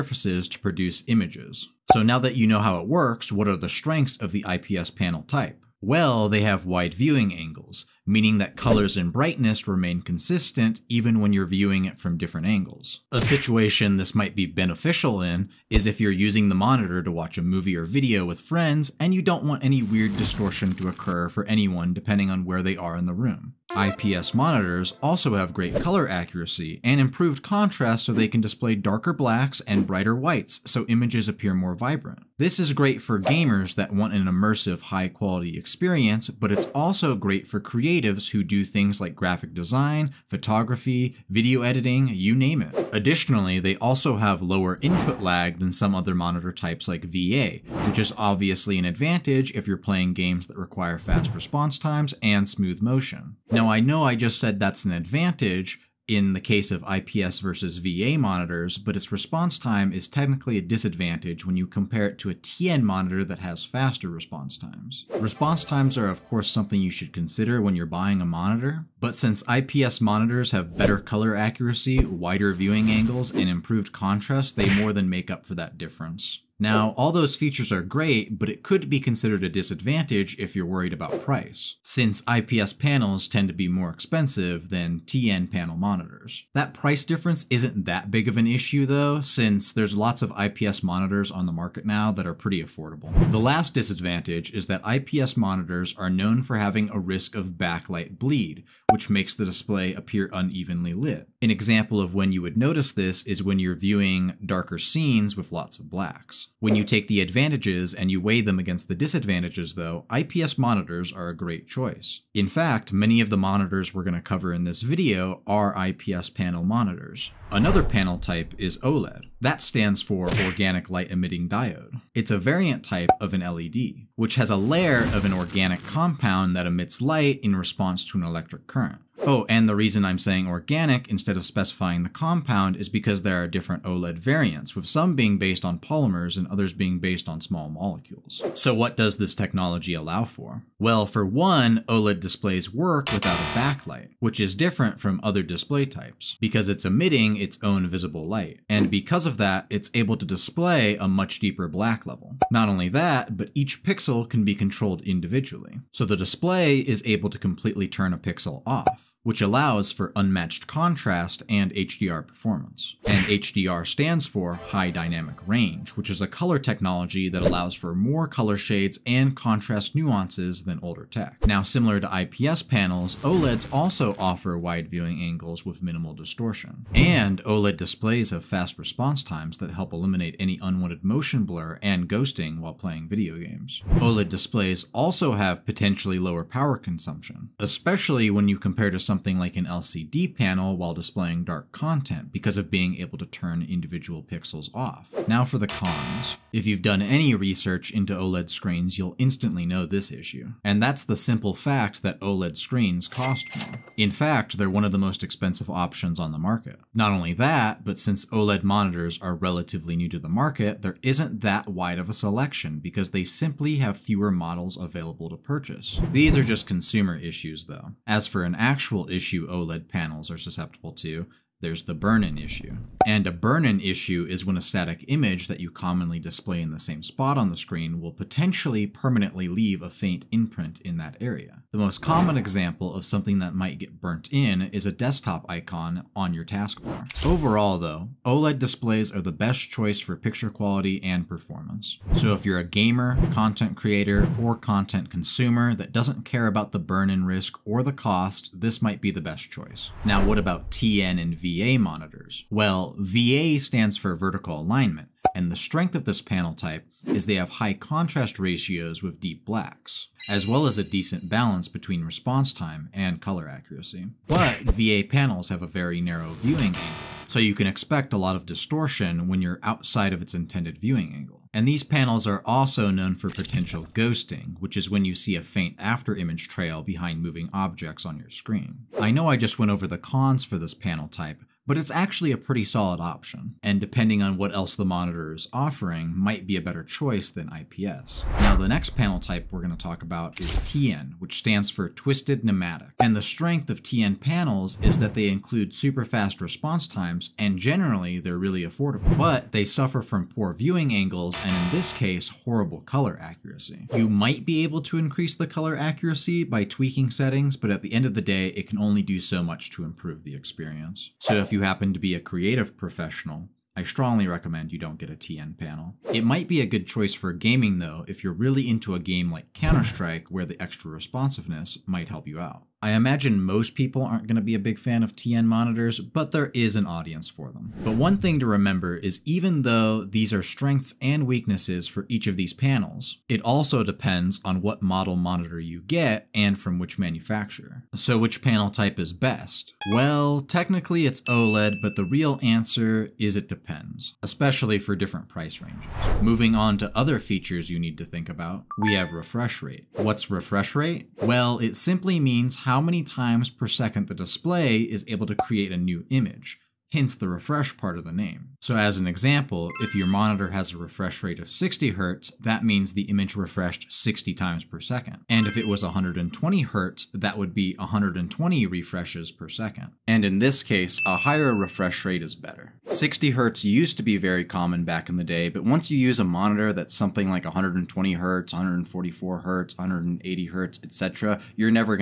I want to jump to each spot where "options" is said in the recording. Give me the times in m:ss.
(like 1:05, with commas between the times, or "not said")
3:25, 4:42.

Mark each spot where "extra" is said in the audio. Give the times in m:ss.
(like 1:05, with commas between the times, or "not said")
5:20.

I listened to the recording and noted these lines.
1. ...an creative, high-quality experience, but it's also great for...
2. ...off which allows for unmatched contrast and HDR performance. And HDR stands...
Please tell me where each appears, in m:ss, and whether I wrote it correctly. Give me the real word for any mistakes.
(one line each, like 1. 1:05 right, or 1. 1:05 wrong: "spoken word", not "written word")
1. 0:34 wrong: "immersive", not "creative"
2. 2:38 right.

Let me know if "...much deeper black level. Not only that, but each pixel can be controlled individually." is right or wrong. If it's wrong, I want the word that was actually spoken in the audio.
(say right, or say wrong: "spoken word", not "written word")
right.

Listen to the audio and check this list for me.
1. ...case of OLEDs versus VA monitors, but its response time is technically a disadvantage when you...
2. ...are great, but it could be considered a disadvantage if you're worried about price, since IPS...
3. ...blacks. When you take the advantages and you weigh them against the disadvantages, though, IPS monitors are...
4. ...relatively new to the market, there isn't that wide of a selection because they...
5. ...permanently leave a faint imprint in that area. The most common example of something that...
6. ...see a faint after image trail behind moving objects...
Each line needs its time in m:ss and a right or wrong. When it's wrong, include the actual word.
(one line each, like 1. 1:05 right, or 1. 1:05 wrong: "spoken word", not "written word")
1. 0:56 wrong: "IPS", not "OLEDs"
2. 1:17 right
3. 1:45 right
4. 3:29 right
5. 3:48 right
6. 4:35 right.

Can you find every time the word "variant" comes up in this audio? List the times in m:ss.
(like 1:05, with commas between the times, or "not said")
2:02, 2:14.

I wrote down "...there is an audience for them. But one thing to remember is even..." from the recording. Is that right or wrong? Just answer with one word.
right.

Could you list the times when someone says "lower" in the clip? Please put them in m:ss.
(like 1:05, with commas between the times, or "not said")
0:44, 3:06.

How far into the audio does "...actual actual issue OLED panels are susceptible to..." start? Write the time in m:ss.
3:38.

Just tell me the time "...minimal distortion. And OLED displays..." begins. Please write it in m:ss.
2:55.